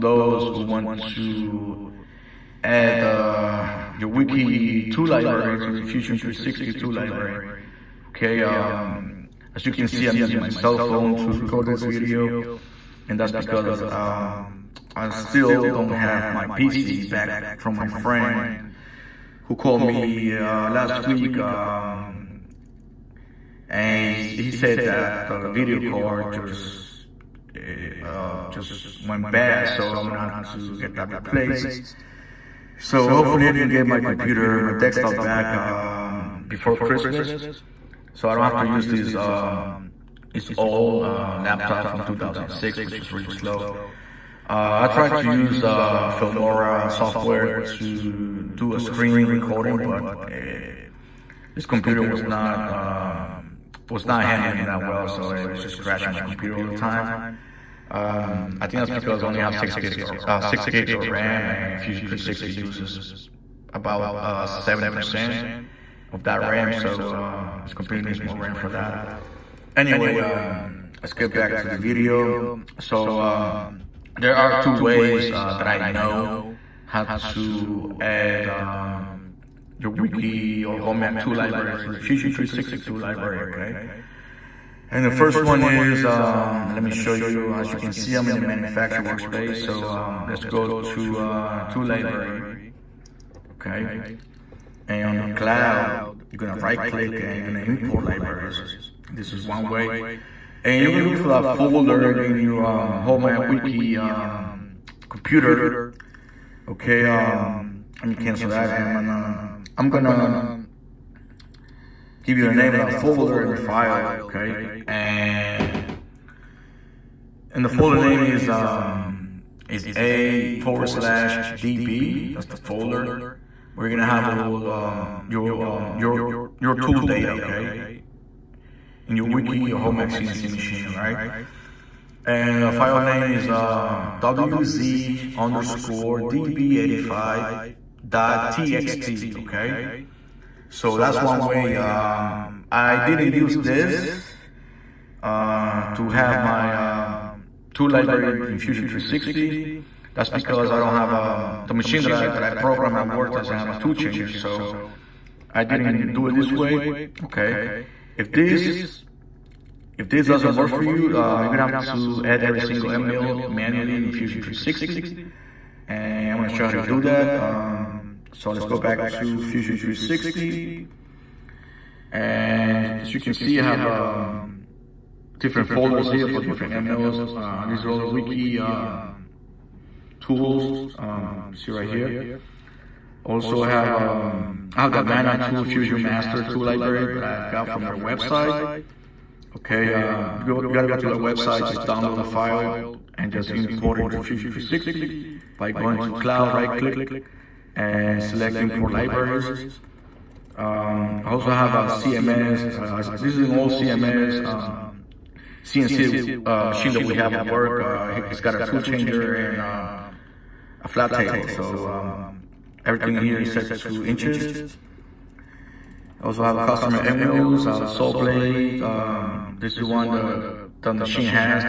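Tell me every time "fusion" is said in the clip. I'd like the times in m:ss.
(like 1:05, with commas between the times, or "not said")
0:05, 1:01, 1:21, 2:28, 2:44, 2:49, 3:05, 3:14.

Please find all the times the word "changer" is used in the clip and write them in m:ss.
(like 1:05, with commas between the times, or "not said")
2:33, 3:28.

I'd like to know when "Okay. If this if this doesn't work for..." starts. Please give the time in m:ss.
2:37.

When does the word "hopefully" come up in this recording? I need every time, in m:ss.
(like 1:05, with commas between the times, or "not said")
0:33.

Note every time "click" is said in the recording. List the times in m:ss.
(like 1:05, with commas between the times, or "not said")
1:36, 3:16.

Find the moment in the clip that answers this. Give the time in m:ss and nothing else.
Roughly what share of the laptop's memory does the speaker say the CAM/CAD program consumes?
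1:04.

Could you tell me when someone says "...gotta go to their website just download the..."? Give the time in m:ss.
3:10.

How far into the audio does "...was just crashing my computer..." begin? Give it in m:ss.
0:55.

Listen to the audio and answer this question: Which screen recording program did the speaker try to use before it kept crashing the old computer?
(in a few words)
Filmora.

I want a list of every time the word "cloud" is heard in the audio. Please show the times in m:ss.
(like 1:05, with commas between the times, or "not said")
1:35, 3:16.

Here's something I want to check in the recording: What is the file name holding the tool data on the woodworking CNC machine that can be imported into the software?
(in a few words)
wz_db85.txt.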